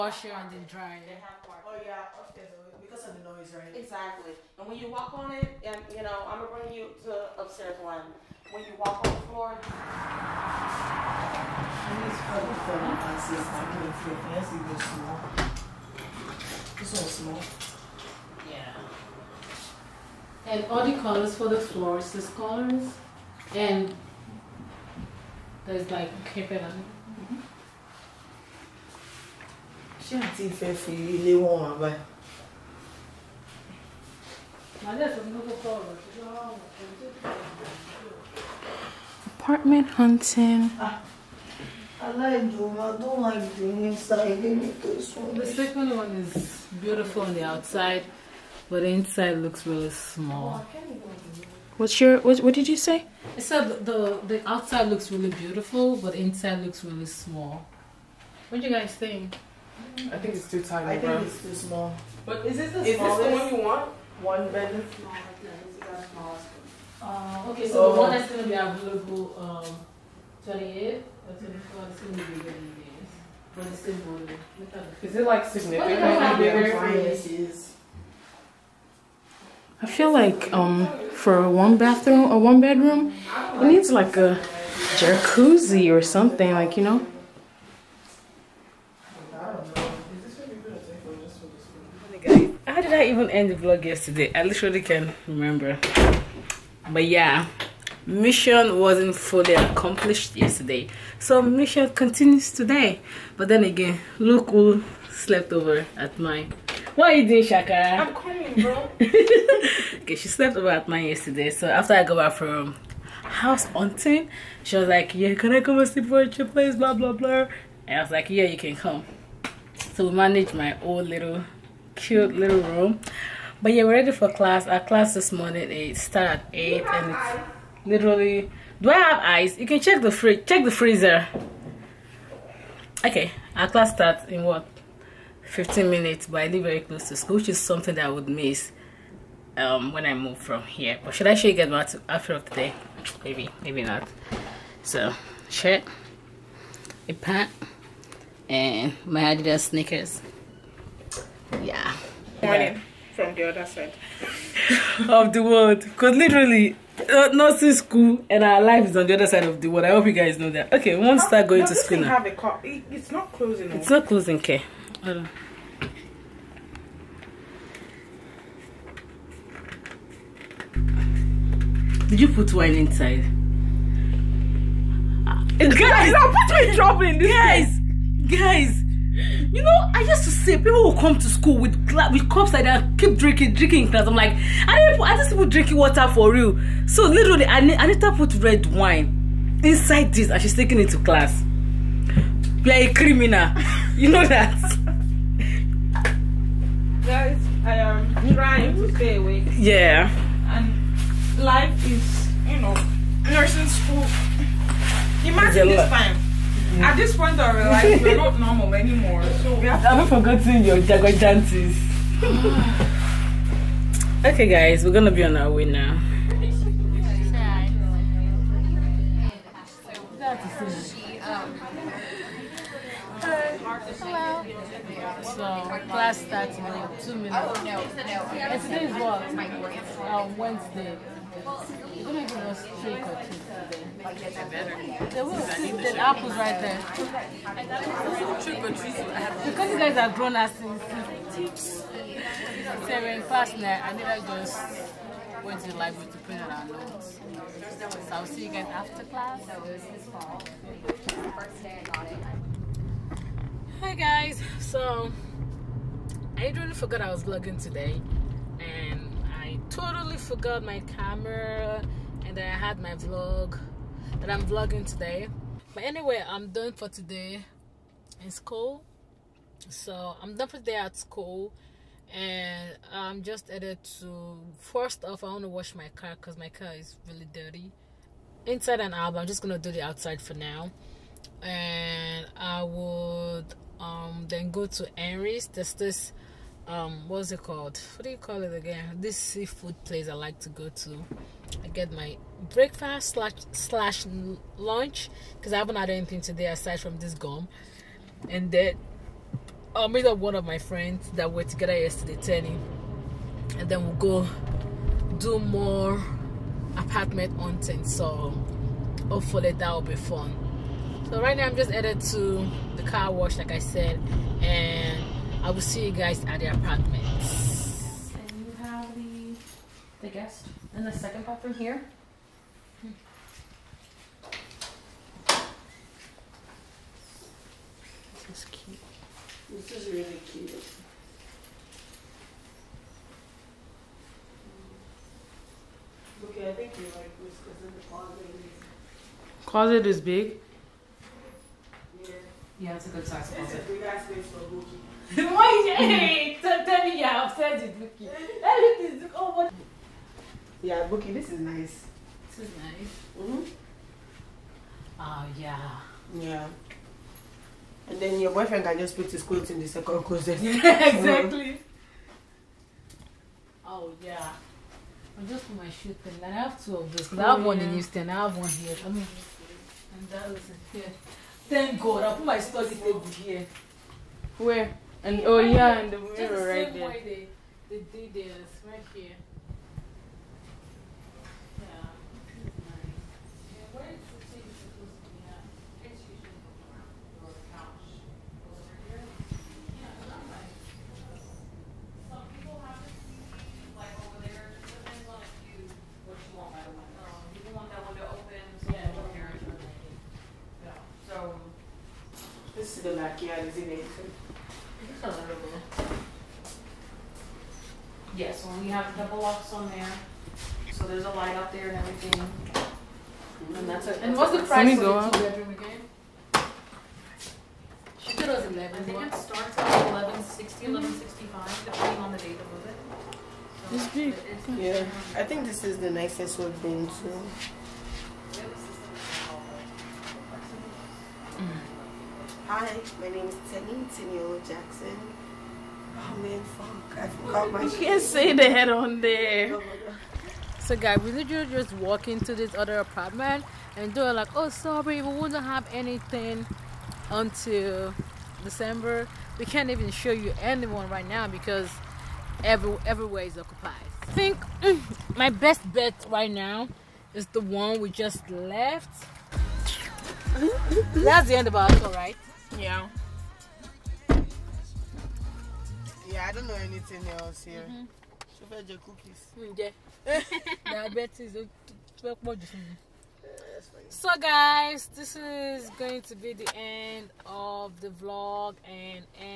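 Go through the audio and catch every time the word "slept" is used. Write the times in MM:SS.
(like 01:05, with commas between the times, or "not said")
01:45, 01:50.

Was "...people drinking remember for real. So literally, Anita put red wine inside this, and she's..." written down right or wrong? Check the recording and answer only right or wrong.
wrong.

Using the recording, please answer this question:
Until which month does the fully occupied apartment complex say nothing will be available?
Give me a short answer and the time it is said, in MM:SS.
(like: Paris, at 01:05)
December, at 07:28.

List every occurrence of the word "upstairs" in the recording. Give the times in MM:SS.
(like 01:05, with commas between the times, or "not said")
00:02, 00:07.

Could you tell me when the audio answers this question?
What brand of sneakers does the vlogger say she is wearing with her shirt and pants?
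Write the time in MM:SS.
02:29.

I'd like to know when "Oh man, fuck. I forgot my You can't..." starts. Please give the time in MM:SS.
07:15.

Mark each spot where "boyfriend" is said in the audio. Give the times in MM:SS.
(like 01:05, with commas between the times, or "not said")
05:58.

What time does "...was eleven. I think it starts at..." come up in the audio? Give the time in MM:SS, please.
06:58.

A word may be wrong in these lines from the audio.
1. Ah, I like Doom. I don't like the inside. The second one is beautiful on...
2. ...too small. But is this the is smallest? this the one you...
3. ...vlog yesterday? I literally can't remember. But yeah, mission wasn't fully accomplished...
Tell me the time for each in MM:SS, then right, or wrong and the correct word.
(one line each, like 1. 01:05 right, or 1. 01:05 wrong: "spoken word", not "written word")
1. 00:40 right
2. 01:01 right
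3. 01:33 right.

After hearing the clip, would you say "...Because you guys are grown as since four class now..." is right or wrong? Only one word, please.
wrong.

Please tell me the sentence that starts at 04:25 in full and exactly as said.
But anyway, I'm done for today in school.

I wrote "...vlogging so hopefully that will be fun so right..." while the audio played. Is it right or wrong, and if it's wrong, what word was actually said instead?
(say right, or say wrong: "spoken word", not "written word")
wrong: "hunting", not "vlogging".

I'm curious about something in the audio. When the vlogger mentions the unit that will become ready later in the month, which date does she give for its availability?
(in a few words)
28th.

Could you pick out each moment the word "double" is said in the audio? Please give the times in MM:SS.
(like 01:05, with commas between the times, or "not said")
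06:48.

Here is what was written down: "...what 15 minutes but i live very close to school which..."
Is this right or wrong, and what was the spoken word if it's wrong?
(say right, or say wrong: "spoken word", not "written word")
right.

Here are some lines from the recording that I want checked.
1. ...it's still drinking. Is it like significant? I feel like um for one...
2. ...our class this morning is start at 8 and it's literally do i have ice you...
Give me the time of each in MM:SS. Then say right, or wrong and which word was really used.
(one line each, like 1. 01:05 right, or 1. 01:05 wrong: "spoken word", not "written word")
1. 01:13 wrong: "voting", not "drinking"
2. 02:04 right.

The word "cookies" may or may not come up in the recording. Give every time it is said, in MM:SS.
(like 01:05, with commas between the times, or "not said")
03:52, 07:48.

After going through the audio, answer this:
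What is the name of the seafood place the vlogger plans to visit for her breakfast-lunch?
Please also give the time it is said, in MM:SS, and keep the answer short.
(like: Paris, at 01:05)
Henry's, at 04:44.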